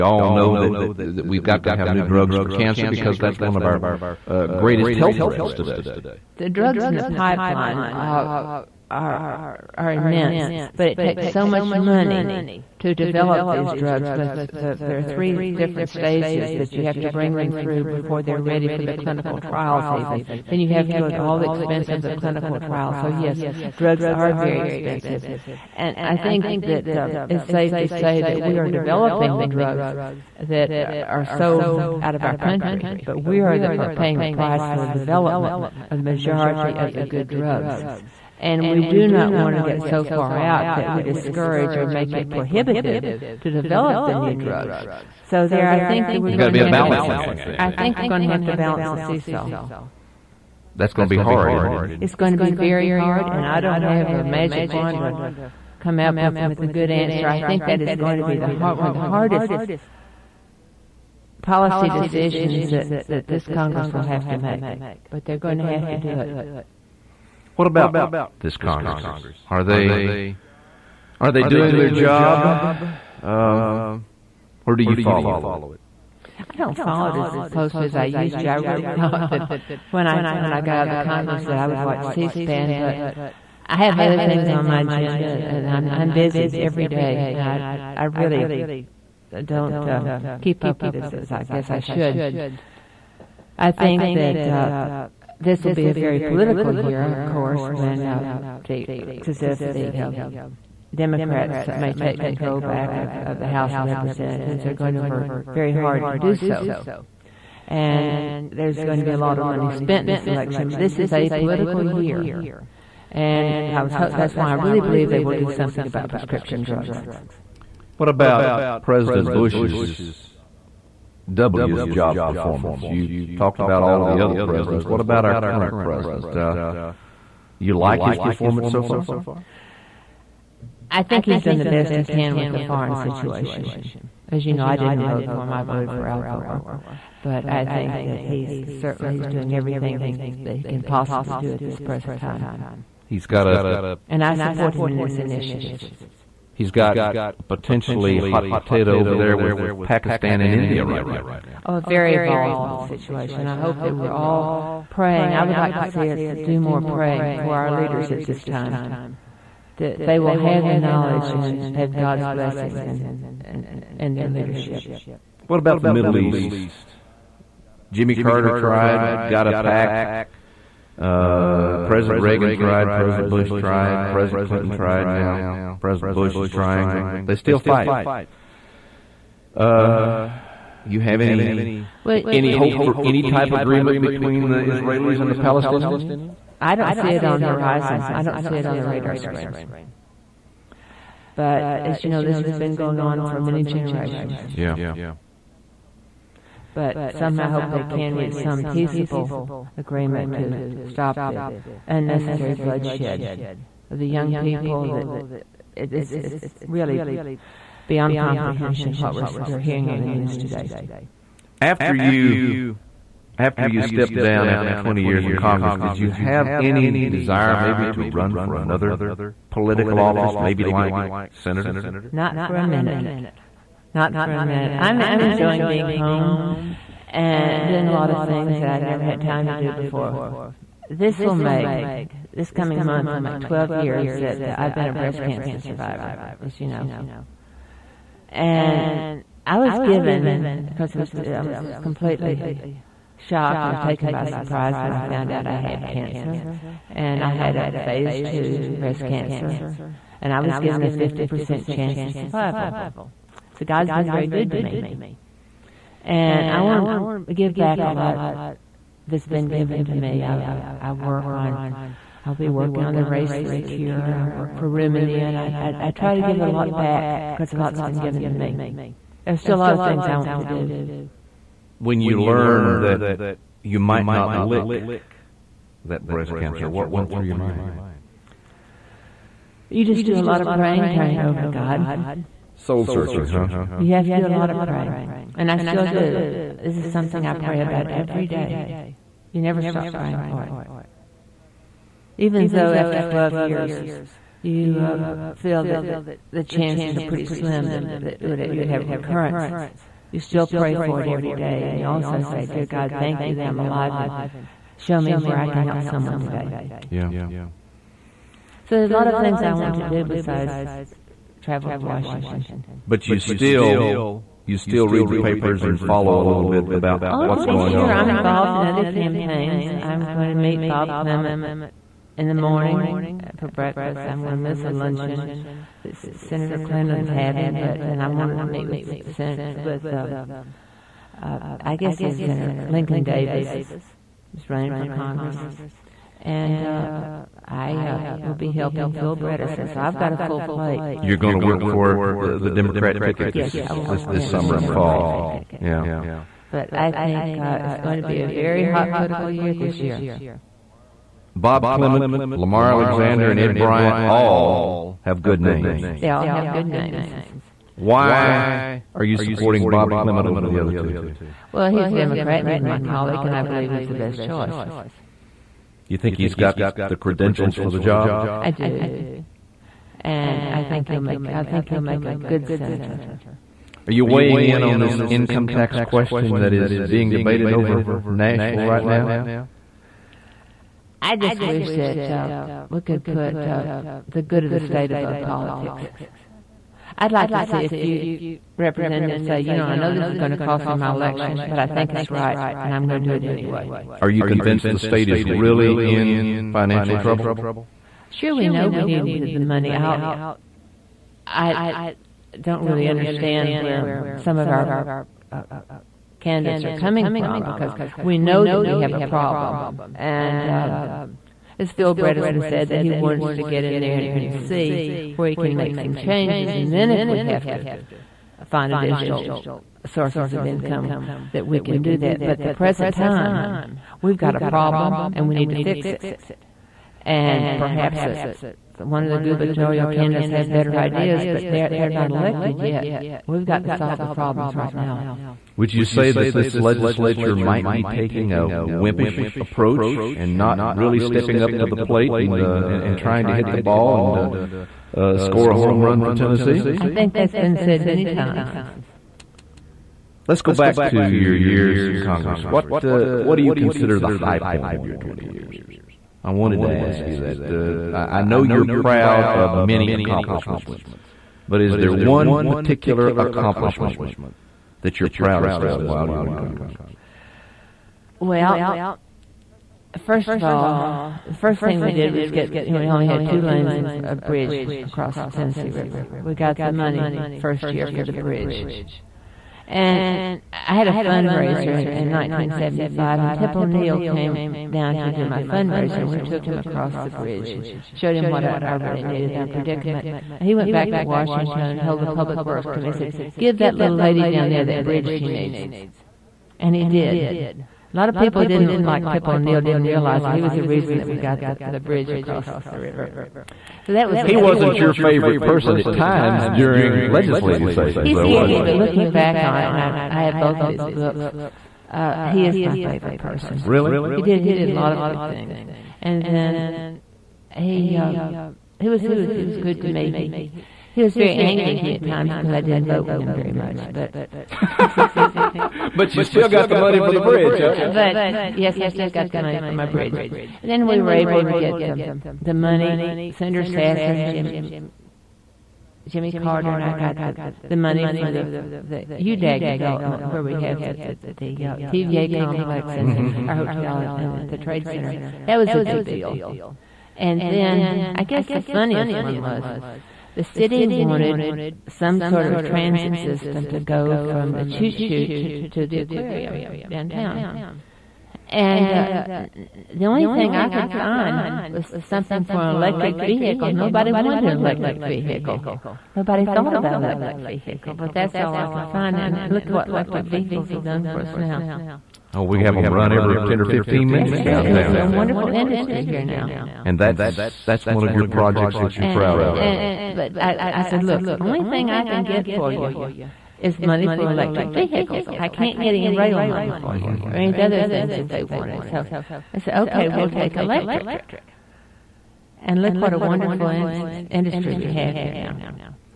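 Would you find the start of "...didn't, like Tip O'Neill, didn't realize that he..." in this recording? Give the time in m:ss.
8:18.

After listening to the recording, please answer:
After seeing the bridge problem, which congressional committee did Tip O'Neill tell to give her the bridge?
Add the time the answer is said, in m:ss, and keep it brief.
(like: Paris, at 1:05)
Public Works Committee, at 8:12.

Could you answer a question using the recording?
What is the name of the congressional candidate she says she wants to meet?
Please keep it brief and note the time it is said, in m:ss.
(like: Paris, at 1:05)
Lincoln Davis, at 5:32.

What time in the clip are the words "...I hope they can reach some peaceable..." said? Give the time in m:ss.
3:17.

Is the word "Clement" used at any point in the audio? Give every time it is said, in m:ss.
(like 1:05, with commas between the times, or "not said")
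5:20, 5:51, 5:59.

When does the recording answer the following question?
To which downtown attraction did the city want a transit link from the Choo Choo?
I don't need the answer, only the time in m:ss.
9:15.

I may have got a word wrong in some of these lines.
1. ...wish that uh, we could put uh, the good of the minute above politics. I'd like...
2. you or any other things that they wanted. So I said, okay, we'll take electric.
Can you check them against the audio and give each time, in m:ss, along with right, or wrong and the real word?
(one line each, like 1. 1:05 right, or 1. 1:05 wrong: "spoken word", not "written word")
1. 6:21 wrong: "state", not "minute"
2. 9:47 right.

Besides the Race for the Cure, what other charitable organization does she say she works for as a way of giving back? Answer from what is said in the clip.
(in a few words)
Room in the Inn.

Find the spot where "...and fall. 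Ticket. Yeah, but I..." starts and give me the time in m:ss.
5:44.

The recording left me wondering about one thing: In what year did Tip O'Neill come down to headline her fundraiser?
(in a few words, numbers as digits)
1975.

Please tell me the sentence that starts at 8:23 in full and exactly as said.
So that was he wasn't your favorite person at times during legislative sessions.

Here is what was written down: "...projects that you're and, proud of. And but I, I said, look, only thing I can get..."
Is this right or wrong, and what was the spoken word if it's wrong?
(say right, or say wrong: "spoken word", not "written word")
right.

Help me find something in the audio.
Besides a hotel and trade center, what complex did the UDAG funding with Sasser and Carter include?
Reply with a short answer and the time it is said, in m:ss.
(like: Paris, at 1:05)
TVA complex, at 9:01.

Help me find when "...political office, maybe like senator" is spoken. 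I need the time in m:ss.
3:39.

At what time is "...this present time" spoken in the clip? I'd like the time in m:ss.
2:21.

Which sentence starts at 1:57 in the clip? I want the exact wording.
What about President Bush's W's job performance?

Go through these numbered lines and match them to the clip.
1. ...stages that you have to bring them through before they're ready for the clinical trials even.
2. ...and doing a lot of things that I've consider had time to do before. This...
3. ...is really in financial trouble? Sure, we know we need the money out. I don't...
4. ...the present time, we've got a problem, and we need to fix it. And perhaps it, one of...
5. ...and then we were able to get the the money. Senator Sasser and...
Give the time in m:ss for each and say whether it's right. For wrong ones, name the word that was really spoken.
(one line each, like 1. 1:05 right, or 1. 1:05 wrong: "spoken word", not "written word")
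1. 0:15 right
2. 3:47 wrong: "never", not "consider"
3. 6:35 right
4. 7:02 right
5. 8:50 right.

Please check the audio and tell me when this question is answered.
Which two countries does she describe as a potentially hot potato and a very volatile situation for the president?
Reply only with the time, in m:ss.
2:29.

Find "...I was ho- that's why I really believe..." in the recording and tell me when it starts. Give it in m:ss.
1:53.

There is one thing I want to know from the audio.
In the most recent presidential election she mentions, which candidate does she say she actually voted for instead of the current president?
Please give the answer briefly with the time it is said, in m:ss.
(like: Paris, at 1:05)
Al Gore, at 2:16.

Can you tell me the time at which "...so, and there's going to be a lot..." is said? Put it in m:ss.
1:46.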